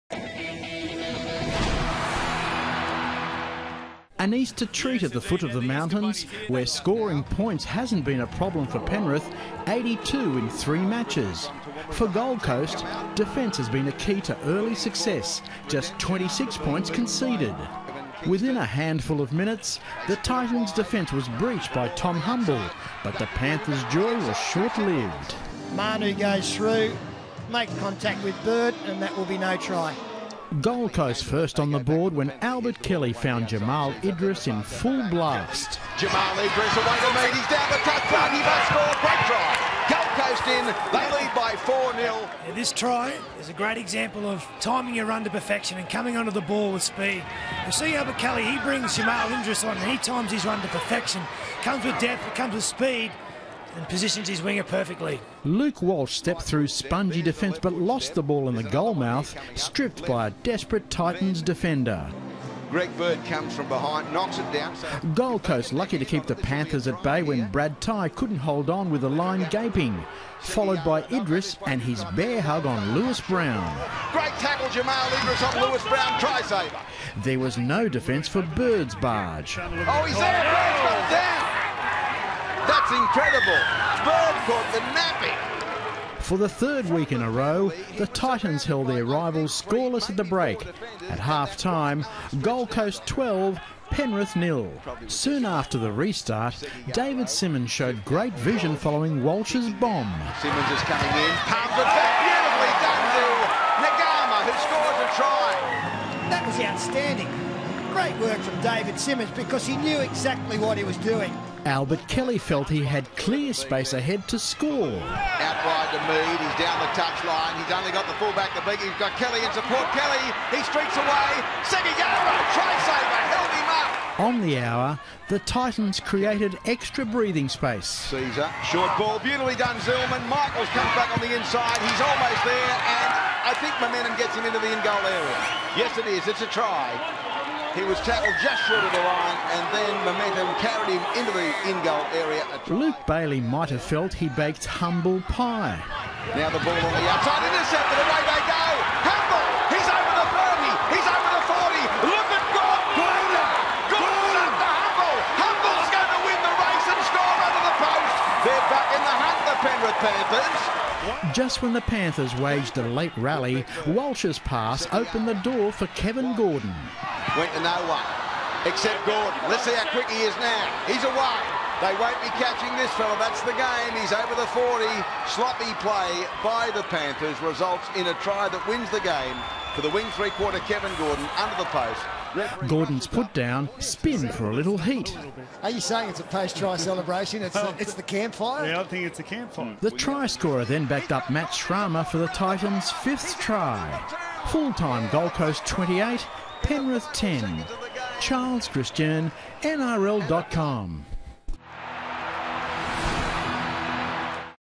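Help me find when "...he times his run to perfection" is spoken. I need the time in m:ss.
0:49.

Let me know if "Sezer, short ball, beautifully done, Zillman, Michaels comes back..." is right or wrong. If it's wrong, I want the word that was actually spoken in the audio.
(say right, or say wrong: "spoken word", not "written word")
right.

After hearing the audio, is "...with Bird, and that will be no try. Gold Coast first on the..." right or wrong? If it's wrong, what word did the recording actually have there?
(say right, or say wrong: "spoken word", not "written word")
right.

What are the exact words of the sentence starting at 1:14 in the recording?
Great tackle, Jamal Idris on Lewis Brown, try saver.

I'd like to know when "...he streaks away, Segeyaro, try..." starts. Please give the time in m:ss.
2:00.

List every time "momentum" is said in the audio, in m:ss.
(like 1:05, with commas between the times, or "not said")
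2:13, 2:20.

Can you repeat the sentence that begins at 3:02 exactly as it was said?
Gordon's put down, spin for a little heat.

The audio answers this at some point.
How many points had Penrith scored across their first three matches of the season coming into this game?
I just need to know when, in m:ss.
0:09.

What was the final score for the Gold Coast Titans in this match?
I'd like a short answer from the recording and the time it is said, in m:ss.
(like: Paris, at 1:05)
28, at 3:15.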